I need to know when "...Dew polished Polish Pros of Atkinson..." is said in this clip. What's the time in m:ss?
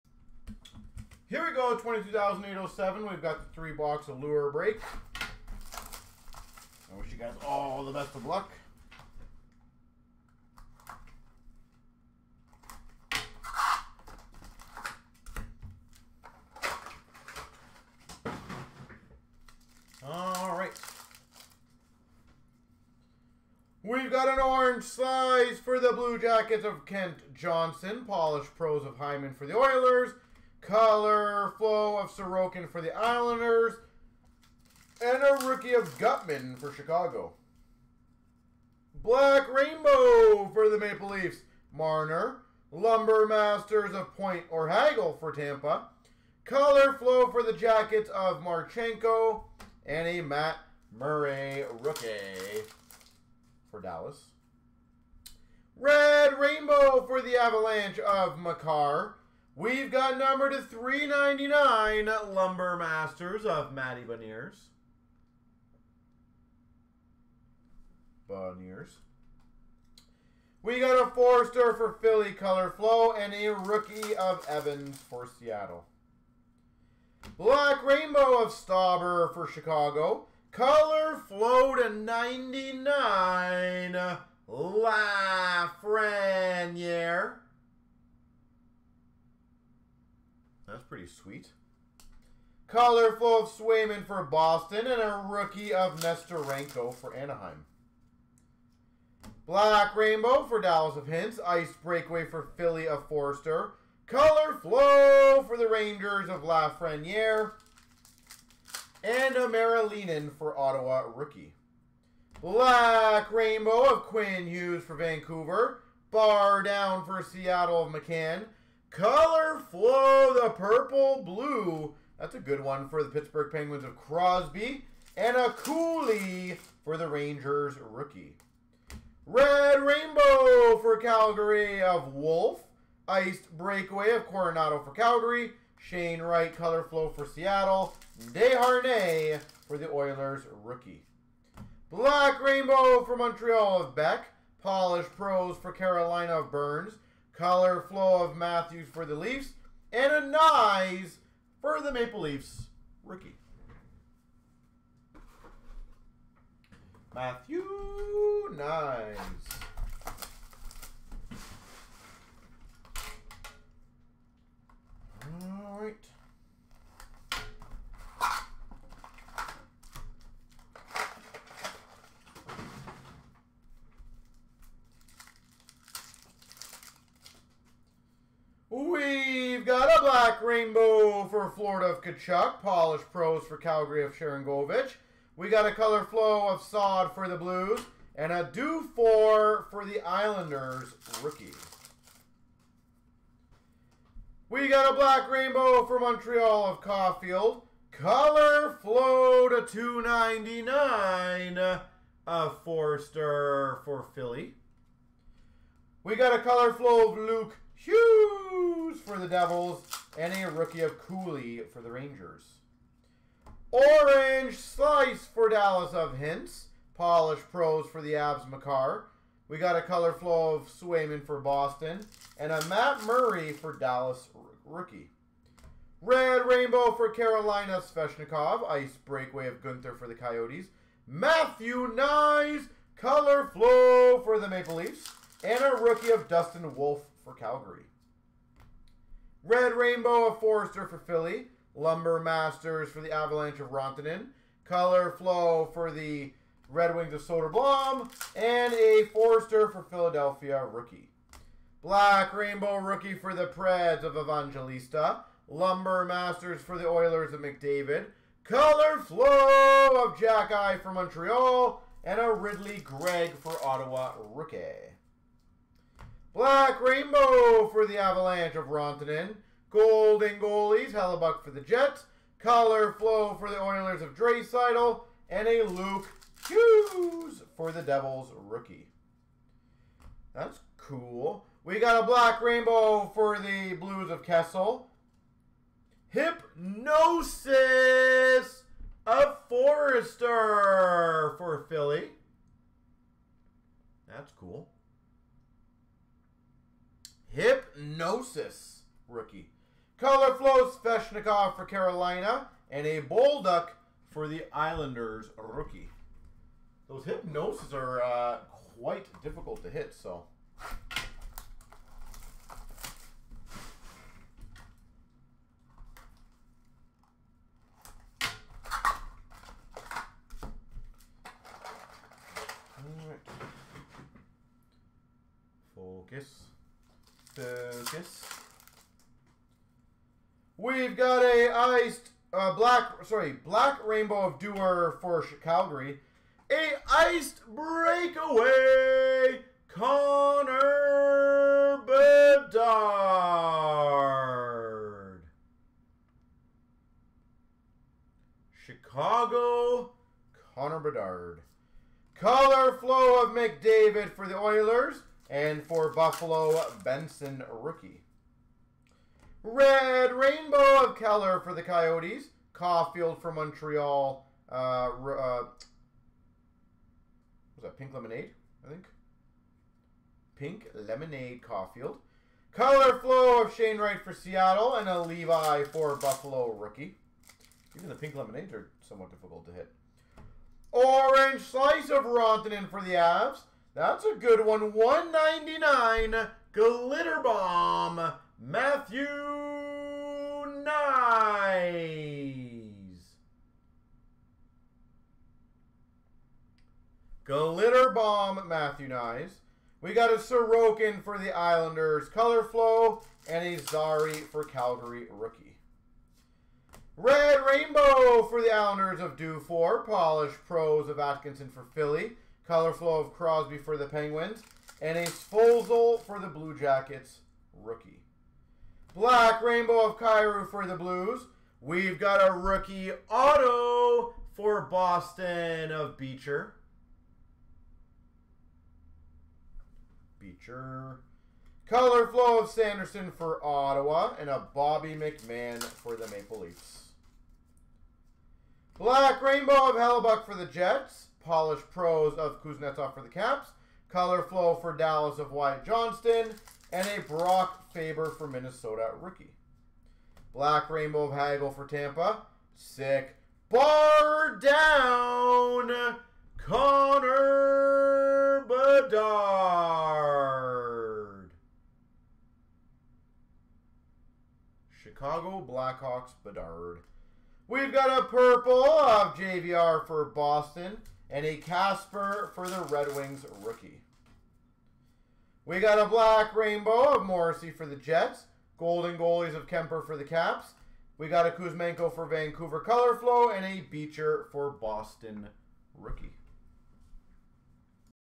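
6:49.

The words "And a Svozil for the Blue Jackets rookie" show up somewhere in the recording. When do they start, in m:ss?
6:54.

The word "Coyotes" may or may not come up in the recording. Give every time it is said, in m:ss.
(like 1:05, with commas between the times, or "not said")
3:50, 6:01.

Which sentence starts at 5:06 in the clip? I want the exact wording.
Those hypnosis are uh, quite difficult to hit, so.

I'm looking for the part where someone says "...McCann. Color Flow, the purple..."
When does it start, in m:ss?
1:57.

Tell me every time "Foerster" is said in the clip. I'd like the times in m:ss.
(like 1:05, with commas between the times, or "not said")
1:11, 1:43, 3:22, 4:00, 4:09, 4:49.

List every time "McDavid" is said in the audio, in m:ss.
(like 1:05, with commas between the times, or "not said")
4:17, 5:53.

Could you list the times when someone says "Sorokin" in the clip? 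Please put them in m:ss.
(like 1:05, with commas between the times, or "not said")
0:32, 6:40.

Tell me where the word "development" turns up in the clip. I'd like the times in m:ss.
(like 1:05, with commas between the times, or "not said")
not said.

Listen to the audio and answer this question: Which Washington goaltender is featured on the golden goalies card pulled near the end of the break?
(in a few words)
Kuemper.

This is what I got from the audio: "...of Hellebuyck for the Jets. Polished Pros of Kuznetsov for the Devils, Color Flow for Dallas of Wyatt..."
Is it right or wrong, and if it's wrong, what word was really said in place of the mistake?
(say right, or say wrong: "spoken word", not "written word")
wrong: "Caps", not "Devils".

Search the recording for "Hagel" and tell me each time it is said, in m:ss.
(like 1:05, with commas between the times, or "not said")
0:44, 7:31.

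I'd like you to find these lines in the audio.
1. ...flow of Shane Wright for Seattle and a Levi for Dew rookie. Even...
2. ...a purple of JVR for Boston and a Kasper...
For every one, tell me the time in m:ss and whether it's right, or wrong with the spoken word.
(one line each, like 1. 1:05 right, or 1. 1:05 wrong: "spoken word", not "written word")
1. 6:12 wrong: "Buffalo", not "Dew"
2. 7:47 right.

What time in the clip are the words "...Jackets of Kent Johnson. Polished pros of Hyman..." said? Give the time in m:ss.
0:26.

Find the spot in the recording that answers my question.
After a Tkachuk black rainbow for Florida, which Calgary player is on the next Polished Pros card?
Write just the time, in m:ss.
3:04.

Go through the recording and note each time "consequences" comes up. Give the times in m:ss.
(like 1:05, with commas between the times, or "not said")
not said.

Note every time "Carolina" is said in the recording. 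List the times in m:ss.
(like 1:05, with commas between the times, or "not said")
2:25, 3:47, 5:01.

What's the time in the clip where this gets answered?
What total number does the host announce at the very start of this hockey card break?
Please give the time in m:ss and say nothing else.
0:01.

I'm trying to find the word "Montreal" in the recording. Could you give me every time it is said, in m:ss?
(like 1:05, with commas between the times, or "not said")
2:23, 3:15, 4:20, 6:03.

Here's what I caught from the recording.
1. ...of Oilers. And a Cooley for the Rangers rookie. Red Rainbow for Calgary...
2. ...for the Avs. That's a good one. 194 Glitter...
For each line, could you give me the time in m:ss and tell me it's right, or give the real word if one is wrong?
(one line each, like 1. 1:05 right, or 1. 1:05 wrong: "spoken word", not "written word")
1. 2:03 wrong: "Crosby", not "Oilers"
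2. 6:22 wrong: "199", not "194".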